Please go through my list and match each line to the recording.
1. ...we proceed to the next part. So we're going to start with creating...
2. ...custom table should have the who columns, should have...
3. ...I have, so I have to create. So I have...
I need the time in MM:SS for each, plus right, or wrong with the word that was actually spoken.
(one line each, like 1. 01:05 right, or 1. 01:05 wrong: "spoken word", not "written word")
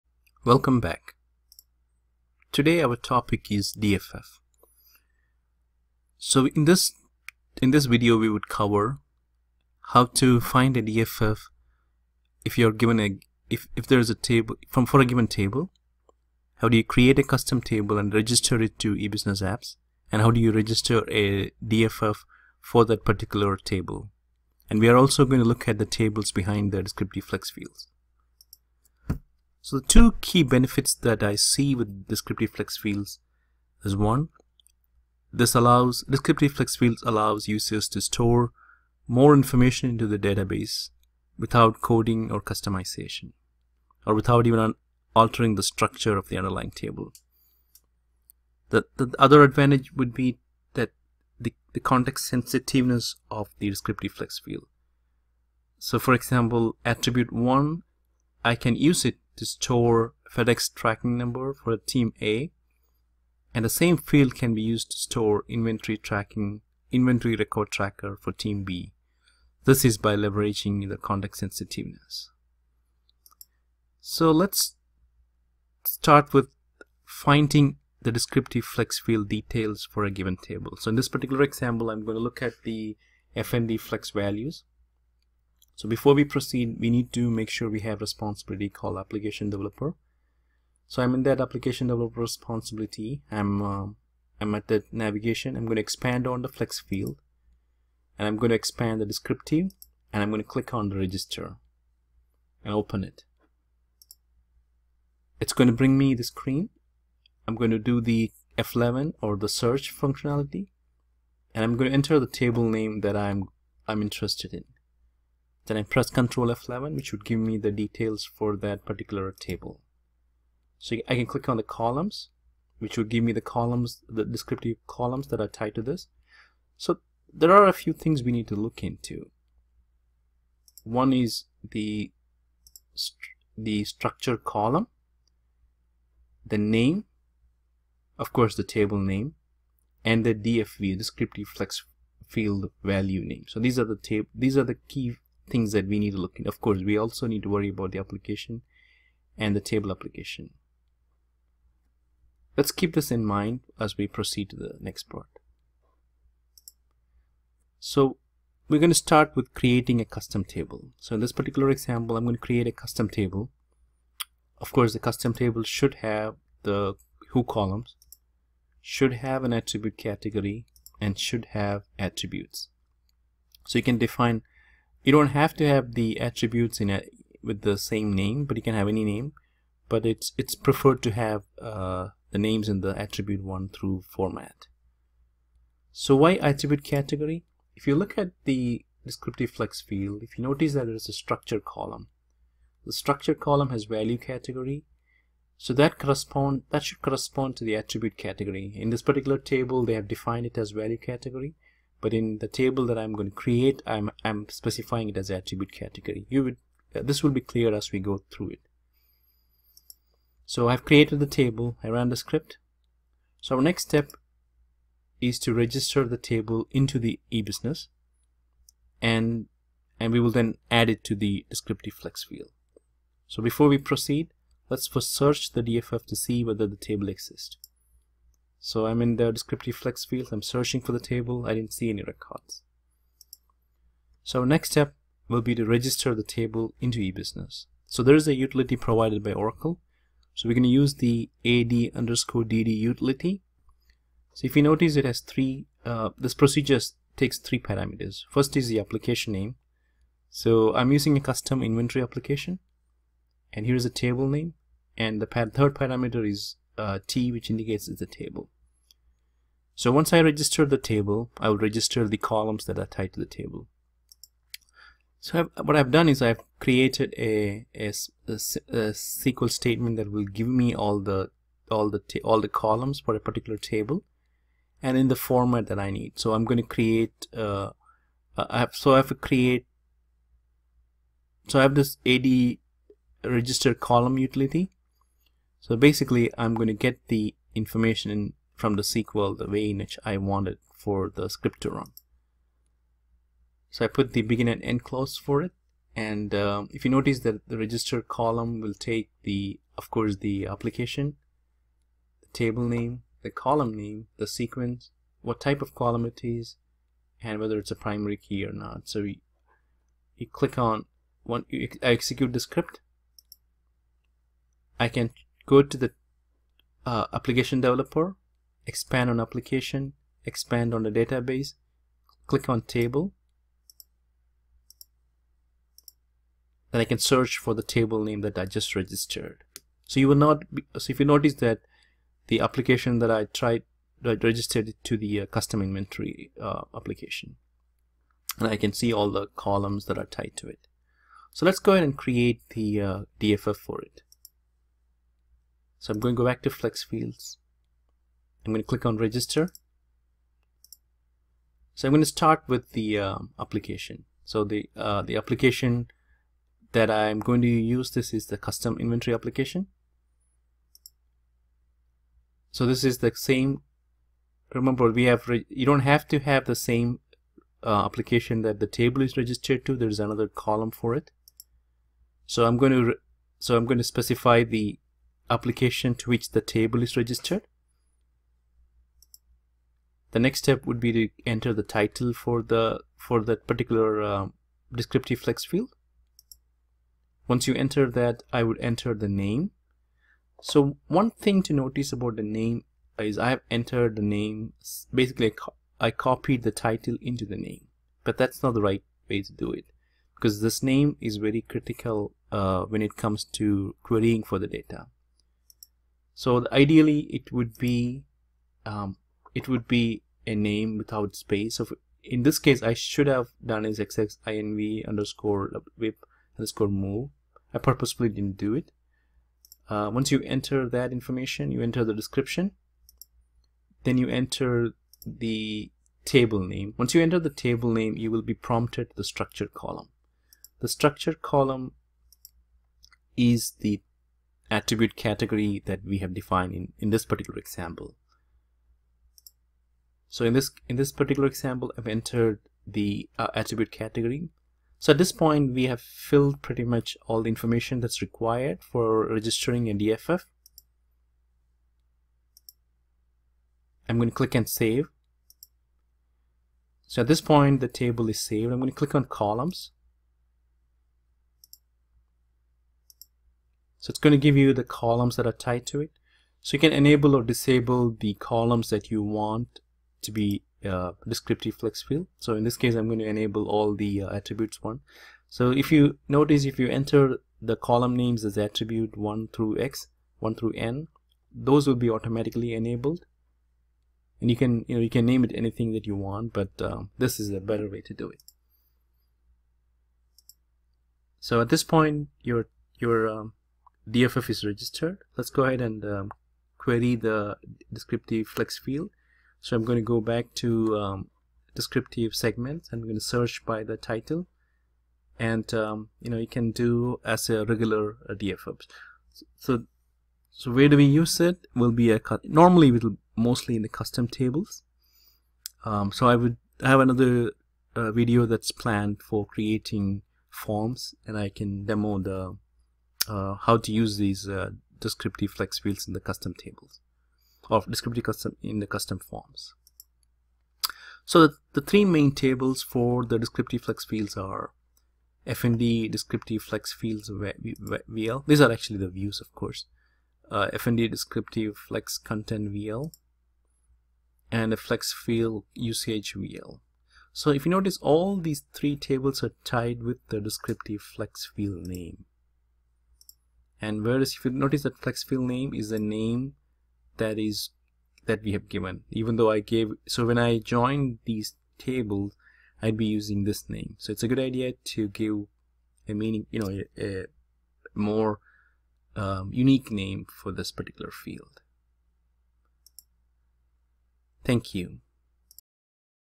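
1. 02:33 right
2. 02:44 right
3. 04:38 right.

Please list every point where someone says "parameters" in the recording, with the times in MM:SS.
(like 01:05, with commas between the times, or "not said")
04:07, 04:15.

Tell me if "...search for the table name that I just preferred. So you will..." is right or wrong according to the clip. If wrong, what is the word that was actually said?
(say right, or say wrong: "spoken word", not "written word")
wrong: "registered", not "preferred".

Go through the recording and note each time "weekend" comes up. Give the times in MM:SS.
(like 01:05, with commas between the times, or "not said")
not said.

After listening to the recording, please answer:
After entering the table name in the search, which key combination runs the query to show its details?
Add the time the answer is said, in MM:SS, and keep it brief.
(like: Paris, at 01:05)
Control F11, at 01:56.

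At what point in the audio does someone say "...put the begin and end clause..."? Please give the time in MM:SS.
04:53.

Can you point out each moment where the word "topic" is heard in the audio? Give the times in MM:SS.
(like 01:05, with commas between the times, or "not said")
00:02.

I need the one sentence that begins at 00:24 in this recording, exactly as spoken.
And we are also going to look at the tables behind the descriptive flex fields.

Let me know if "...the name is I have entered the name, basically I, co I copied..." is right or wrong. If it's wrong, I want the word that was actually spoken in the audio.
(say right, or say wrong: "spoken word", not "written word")
right.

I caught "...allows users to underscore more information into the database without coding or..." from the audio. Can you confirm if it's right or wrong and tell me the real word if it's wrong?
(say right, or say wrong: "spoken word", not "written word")
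wrong: "store", not "underscore".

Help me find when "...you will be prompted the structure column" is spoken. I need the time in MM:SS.
07:07.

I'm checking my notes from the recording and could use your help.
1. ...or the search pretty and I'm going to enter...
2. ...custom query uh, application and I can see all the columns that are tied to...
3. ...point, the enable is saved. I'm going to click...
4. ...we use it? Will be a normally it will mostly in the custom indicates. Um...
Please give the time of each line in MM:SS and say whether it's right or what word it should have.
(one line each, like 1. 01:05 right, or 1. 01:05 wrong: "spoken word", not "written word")
1. 01:49 wrong: "functionality", not "pretty"
2. 05:35 wrong: "inventory", not "query"
3. 07:37 wrong: "table", not "enable"
4. 08:30 wrong: "tables", not "indicates".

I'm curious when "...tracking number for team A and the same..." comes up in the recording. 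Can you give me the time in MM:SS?
01:00.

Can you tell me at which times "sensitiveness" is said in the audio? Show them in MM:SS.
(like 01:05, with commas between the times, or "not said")
00:52, 01:11.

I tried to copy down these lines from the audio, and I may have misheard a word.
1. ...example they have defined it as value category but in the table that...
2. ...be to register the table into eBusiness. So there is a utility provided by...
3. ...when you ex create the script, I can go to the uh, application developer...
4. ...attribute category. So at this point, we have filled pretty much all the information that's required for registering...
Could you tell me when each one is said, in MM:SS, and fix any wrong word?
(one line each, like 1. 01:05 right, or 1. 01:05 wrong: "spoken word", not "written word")
1. 03:19 wrong: "table", not "example"
2. 03:55 right
3. 05:11 wrong: "execute", not "create"
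4. 07:23 right.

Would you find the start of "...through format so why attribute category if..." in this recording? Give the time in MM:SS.
03:03.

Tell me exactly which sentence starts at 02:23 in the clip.
So these are the table, these are the key things that we need to look in.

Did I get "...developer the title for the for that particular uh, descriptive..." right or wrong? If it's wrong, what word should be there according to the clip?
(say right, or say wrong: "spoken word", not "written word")
wrong: "enter", not "developer".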